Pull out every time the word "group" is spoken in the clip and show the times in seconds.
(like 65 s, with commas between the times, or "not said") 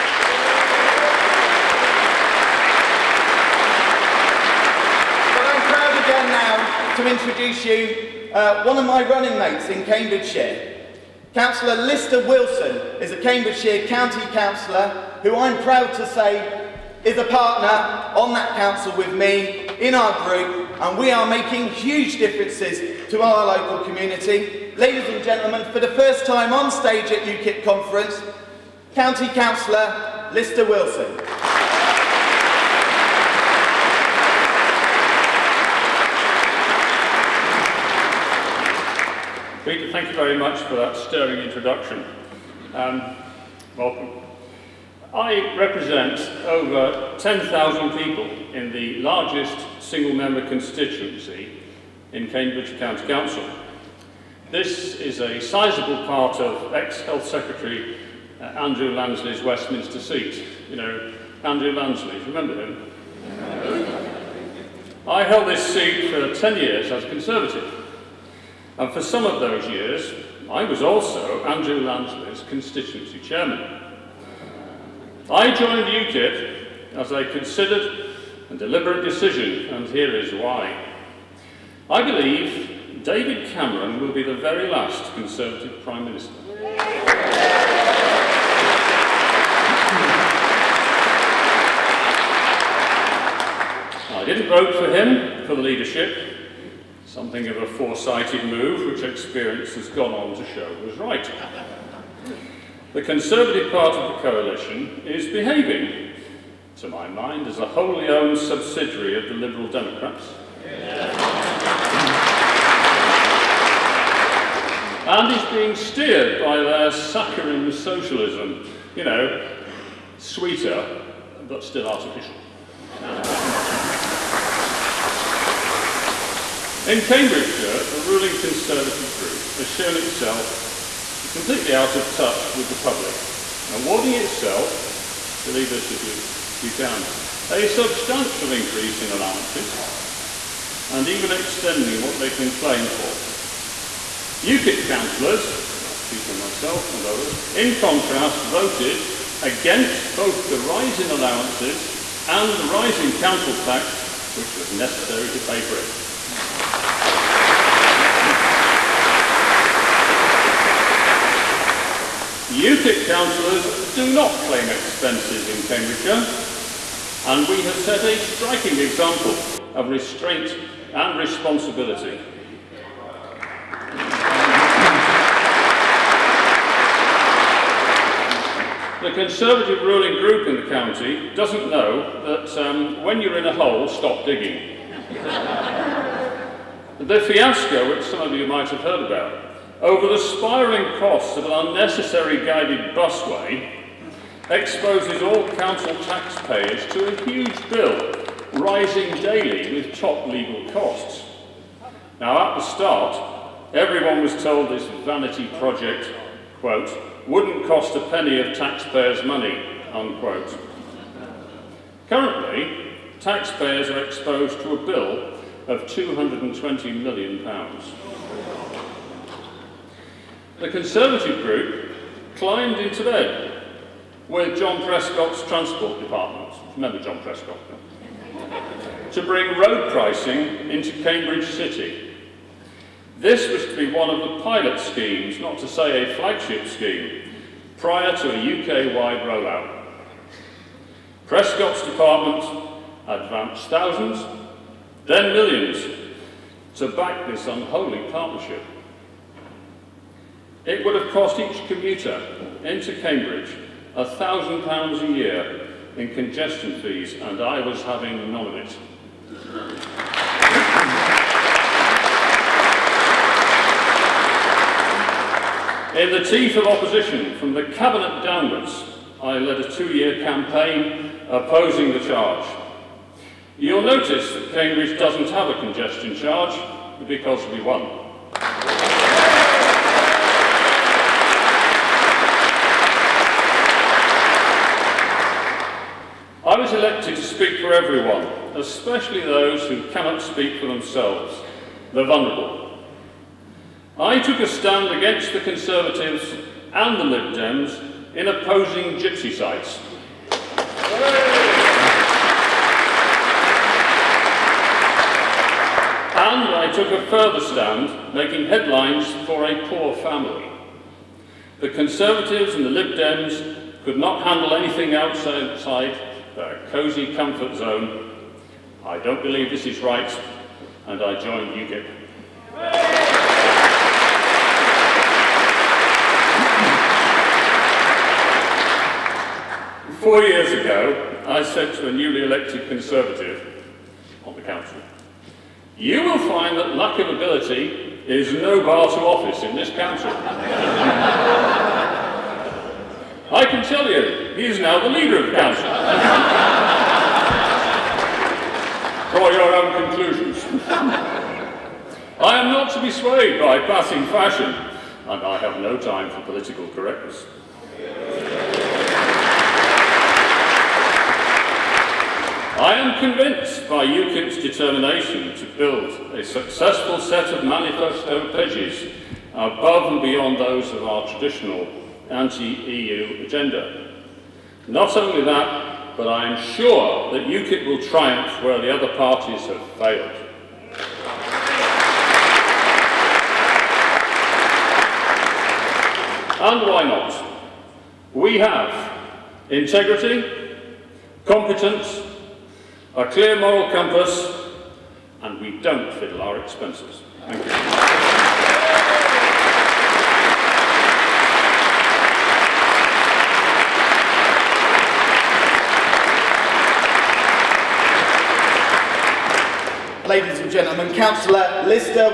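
20 s, 129 s, 180 s, 221 s.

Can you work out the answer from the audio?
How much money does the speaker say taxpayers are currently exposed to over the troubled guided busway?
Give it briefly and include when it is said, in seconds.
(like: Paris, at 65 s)
£220 million, at 215 s.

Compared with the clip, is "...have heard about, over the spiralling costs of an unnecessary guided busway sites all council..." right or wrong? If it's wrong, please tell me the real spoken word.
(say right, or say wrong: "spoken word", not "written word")
wrong: "exposes", not "sites".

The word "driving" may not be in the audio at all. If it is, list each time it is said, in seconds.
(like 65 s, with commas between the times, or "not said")
not said.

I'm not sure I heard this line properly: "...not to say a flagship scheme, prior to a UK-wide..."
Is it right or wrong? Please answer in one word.
right.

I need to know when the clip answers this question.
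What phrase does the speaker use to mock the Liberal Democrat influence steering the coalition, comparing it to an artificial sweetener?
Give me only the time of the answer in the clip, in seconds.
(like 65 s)
116 s.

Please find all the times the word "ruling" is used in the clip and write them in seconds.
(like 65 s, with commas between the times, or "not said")
127 s, 179 s.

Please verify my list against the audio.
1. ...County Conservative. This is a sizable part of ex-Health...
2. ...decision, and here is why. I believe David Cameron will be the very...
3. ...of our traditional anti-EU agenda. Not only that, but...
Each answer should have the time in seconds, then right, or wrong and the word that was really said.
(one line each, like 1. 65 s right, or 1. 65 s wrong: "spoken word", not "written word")
1. 52 s wrong: "Council", not "Conservative"
2. 79 s right
3. 370 s right.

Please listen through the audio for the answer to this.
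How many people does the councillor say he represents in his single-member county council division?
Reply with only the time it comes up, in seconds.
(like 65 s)
46 s.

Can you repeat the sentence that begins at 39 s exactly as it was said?
Peter, thank you very much for that stirring introduction.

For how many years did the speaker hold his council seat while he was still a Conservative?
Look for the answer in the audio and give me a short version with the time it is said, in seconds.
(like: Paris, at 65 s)
10 years, at 66 s.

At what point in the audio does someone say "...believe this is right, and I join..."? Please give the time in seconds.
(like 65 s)
319 s.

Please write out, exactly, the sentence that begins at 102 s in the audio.
The Conservative part of the coalition is behaving, to my mind, as a wholly owned subsidiary of the Liberal Democrats.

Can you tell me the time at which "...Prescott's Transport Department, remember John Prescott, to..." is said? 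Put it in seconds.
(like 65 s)
224 s.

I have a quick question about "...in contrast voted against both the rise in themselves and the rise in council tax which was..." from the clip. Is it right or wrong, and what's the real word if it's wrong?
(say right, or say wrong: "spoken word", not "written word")
wrong: "allowances", not "themselves".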